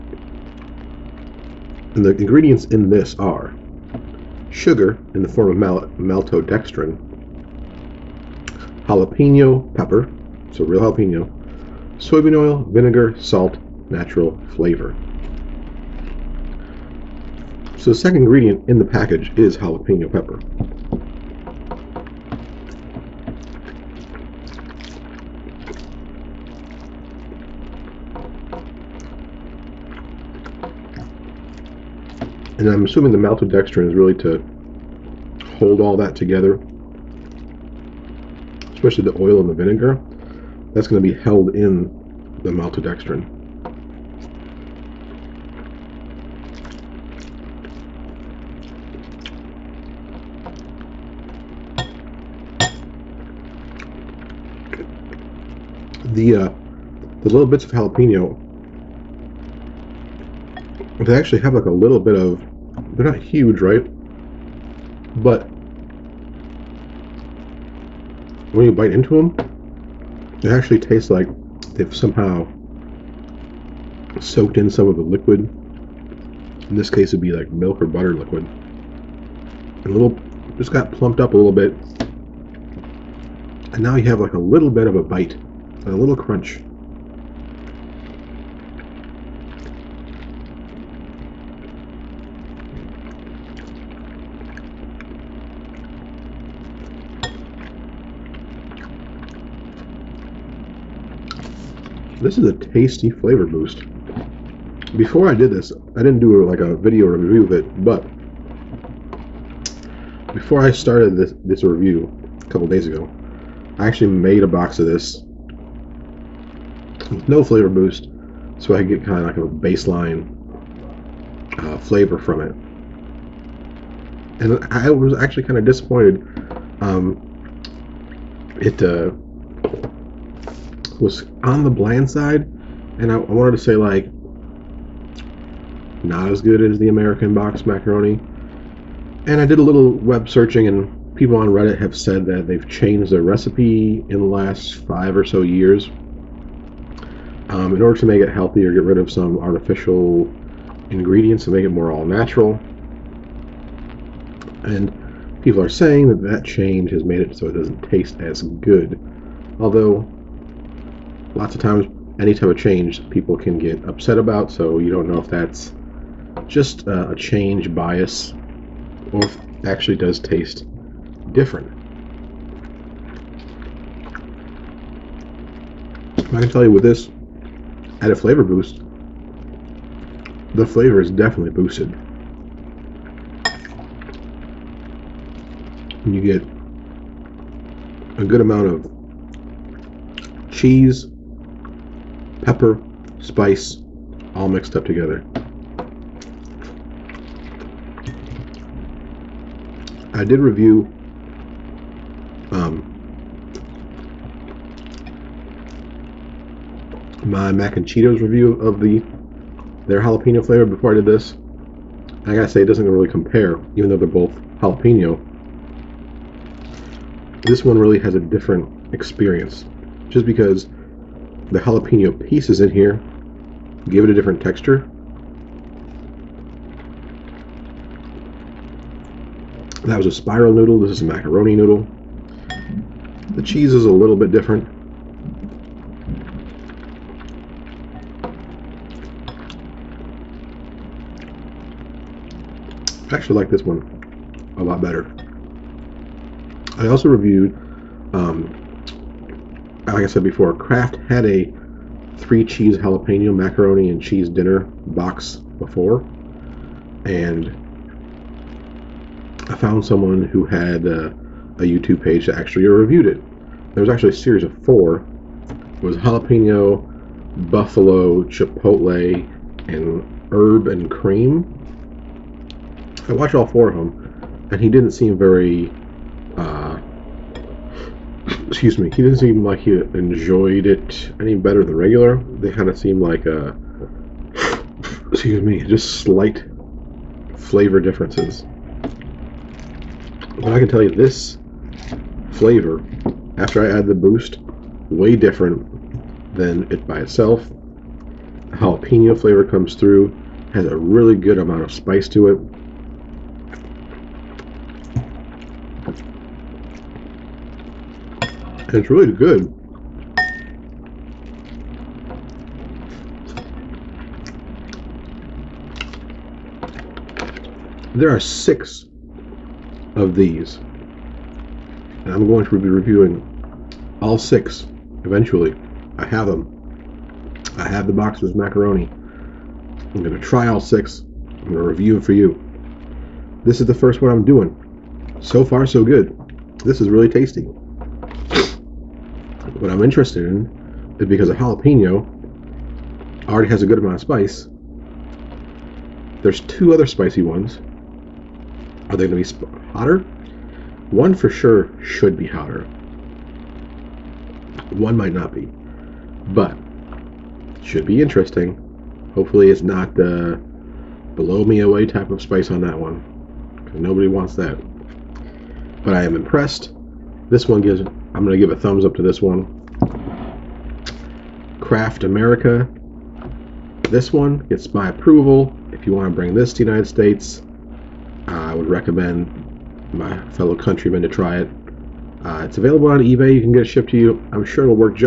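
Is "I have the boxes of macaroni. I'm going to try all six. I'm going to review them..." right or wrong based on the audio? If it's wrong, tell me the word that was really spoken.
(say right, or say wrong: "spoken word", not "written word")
right.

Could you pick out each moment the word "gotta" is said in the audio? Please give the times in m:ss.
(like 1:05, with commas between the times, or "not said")
3:32.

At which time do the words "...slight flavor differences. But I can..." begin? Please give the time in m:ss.
4:46.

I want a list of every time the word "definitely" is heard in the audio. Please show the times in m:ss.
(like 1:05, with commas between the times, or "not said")
3:01.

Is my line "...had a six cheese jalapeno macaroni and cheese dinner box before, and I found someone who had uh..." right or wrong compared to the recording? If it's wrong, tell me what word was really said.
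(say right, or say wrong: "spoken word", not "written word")
wrong: "three", not "six".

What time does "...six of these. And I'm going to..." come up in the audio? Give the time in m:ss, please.
5:18.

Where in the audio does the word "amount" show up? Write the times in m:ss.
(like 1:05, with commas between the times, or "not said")
3:08, 5:01, 5:43.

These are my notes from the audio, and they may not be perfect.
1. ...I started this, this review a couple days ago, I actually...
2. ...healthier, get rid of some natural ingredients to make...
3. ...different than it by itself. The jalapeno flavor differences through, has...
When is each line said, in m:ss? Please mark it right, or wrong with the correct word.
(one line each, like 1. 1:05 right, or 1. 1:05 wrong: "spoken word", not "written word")
1. 1:50 right
2. 2:28 wrong: "artificial", not "natural"
3. 4:55 wrong: "comes", not "differences".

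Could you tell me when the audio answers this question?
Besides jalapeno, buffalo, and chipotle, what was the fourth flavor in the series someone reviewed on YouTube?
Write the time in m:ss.
4:30.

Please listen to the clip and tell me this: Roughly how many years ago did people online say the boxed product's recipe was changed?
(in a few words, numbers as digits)
5.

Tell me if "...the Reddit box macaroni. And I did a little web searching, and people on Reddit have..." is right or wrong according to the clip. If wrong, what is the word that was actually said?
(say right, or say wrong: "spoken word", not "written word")
wrong: "American", not "Reddit".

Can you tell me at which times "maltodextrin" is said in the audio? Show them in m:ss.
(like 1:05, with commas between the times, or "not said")
0:05, 0:33, 0:42.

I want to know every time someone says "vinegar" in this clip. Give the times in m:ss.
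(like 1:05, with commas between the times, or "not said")
0:12, 0:39.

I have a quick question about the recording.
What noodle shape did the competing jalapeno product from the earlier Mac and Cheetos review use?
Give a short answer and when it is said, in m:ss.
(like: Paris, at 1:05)
spiral, at 3:50.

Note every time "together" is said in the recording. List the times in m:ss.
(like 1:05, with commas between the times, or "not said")
0:36, 3:14.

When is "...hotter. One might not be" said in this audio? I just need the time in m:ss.
5:52.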